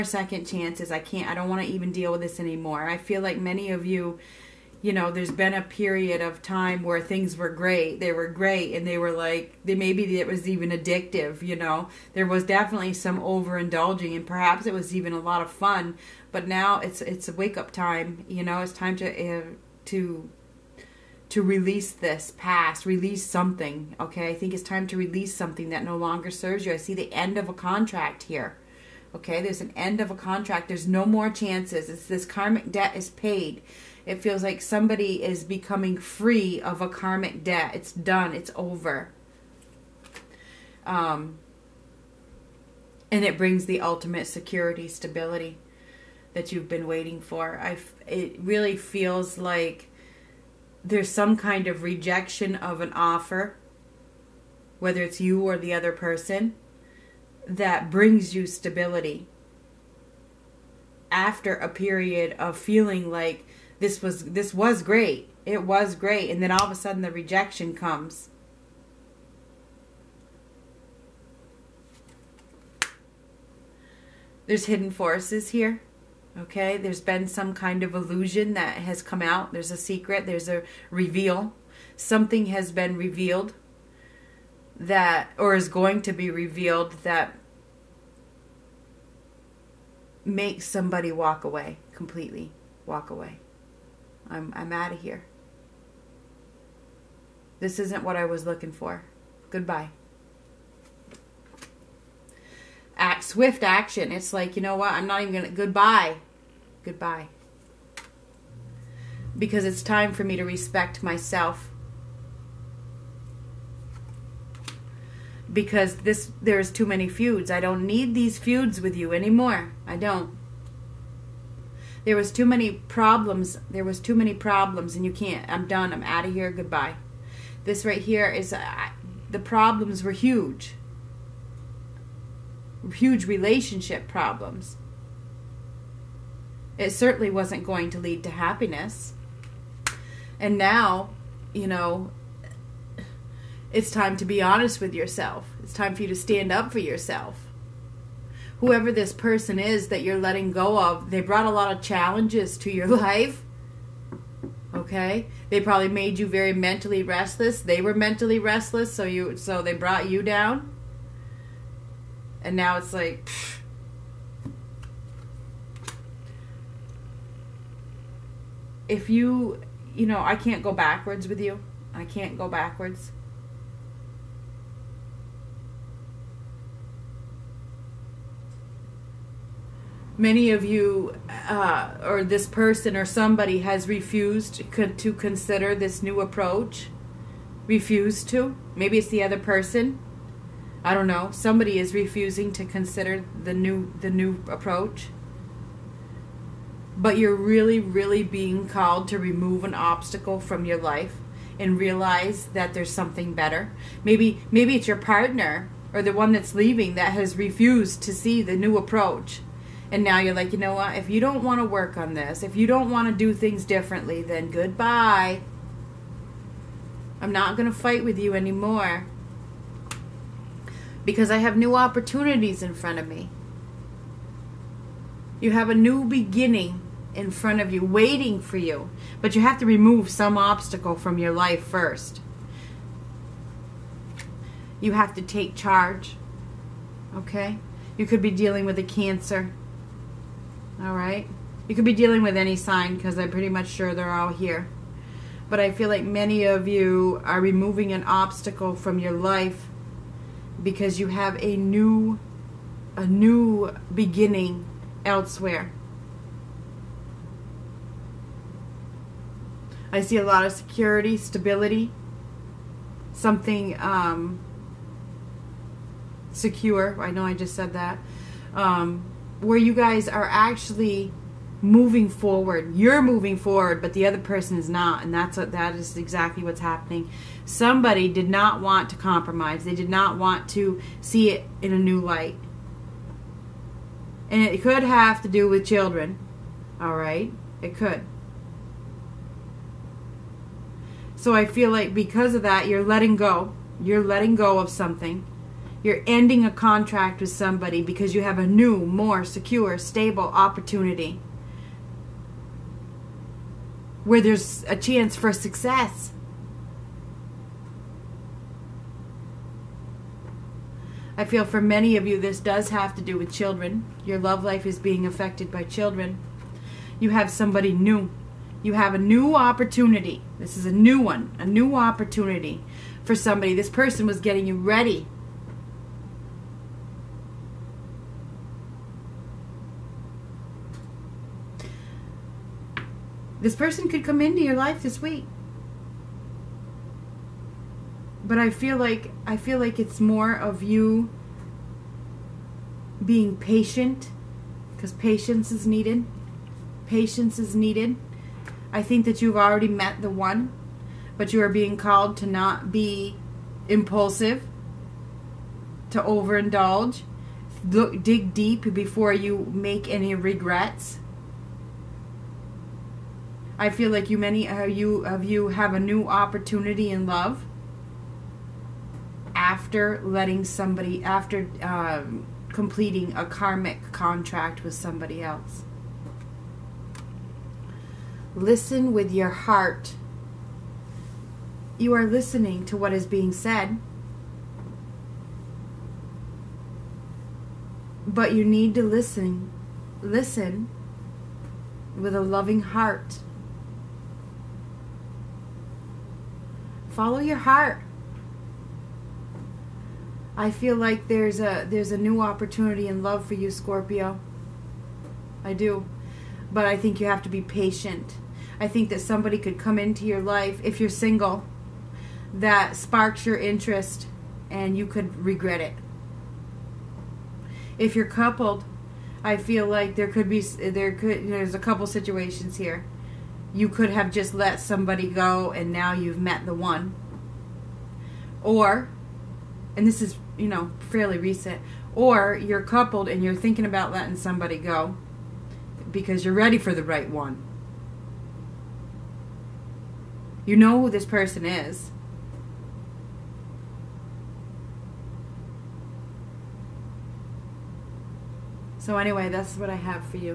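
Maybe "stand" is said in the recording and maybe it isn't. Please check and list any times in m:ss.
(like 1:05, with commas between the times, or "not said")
2:26.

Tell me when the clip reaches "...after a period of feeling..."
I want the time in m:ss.
1:01.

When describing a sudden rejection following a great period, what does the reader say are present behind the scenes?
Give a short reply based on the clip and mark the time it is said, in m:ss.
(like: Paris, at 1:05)
hidden forces, at 1:14.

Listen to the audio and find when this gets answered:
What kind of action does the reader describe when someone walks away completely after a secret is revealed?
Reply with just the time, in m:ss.
1:43.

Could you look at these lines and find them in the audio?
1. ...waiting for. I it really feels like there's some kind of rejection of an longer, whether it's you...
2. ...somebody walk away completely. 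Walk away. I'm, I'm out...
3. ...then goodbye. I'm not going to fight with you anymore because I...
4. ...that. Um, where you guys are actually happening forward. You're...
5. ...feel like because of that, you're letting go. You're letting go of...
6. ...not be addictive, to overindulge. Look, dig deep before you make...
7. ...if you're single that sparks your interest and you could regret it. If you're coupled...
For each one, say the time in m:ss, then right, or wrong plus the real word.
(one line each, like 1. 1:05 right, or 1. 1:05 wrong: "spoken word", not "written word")
1. 0:46 wrong: "offer", not "longer"
2. 1:30 right
3. 3:34 right
4. 4:27 wrong: "moving", not "happening"
5. 4:51 right
6. 5:52 wrong: "impulsive", not "addictive"
7. 6:50 right.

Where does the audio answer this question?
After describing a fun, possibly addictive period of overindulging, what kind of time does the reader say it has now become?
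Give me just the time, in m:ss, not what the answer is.
0:17.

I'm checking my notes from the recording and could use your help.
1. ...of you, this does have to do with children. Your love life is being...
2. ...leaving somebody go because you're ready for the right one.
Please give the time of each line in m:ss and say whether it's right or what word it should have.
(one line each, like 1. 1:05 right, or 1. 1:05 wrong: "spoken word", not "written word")
1. 5:11 right
2. 7:13 wrong: "letting", not "leaving".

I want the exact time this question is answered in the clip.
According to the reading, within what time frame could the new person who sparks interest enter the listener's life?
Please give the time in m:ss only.
5:34.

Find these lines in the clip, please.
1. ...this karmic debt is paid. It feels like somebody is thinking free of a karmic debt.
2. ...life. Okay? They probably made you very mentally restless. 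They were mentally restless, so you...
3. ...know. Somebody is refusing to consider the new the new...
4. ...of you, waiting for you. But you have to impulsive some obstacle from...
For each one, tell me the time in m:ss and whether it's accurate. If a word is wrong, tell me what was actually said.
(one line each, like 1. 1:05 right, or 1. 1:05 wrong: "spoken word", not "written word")
1. 0:32 wrong: "becoming", not "thinking"
2. 2:32 right
3. 3:11 right
4. 3:47 wrong: "remove", not "impulsive".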